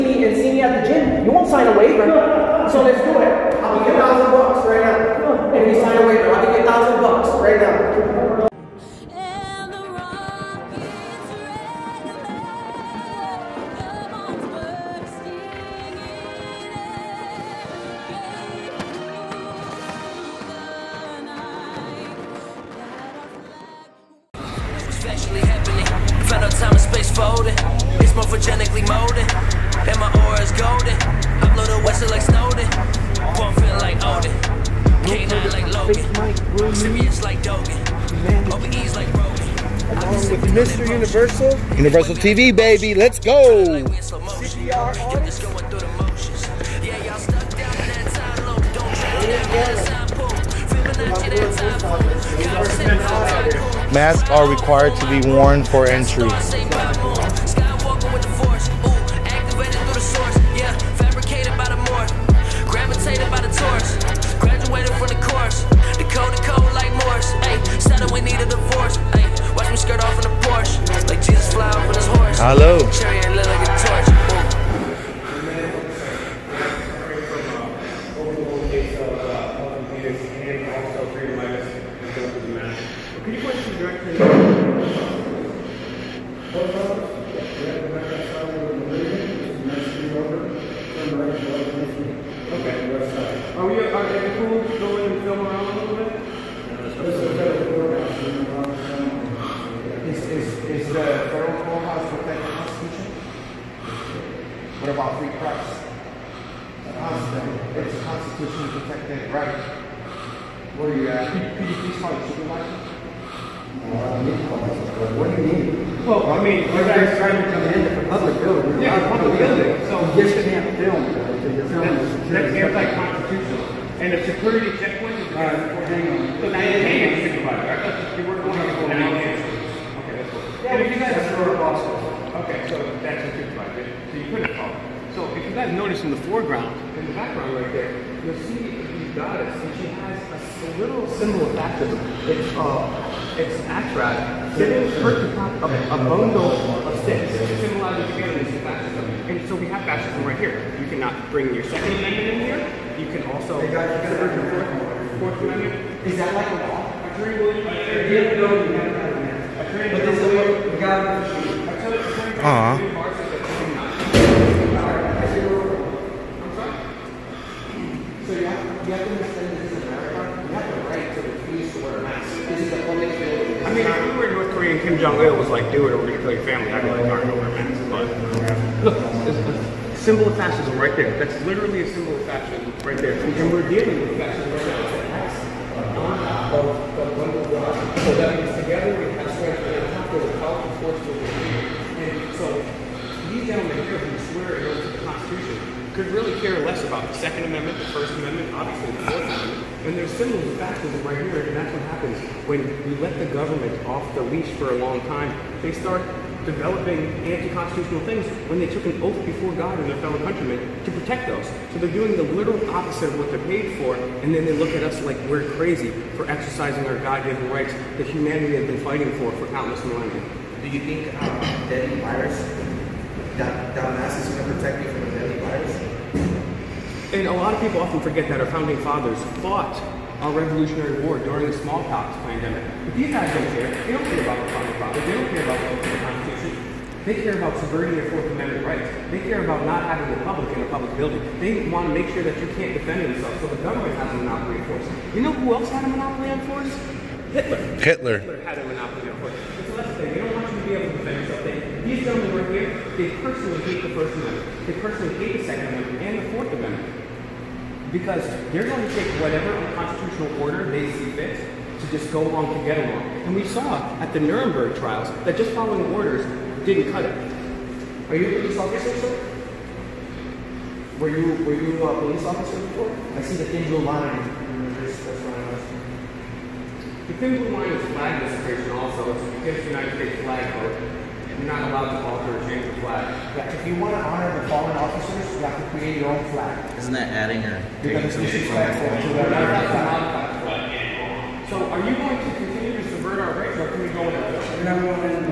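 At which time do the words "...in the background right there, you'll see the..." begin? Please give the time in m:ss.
2:16.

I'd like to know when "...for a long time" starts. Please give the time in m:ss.
3:24.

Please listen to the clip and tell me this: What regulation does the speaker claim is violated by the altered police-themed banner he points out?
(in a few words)
United States flag code.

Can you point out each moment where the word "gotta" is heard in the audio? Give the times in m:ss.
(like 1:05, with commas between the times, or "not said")
2:34.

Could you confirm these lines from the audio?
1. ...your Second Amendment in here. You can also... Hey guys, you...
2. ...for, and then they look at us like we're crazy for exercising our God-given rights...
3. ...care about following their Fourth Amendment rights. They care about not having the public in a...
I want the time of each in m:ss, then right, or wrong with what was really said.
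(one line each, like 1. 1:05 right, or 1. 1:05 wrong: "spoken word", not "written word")
1. 2:31 right
2. 3:33 right
3. 3:57 wrong: "subverting", not "following".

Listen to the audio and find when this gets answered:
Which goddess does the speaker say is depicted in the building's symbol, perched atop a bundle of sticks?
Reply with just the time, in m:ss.
2:23.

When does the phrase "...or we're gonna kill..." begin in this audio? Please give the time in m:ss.
2:55.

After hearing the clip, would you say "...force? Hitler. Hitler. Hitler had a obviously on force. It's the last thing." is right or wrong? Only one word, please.
wrong.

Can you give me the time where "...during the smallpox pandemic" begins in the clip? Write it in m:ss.
3:51.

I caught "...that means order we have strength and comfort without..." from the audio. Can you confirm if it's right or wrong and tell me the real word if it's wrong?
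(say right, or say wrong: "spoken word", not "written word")
wrong: "together", not "order".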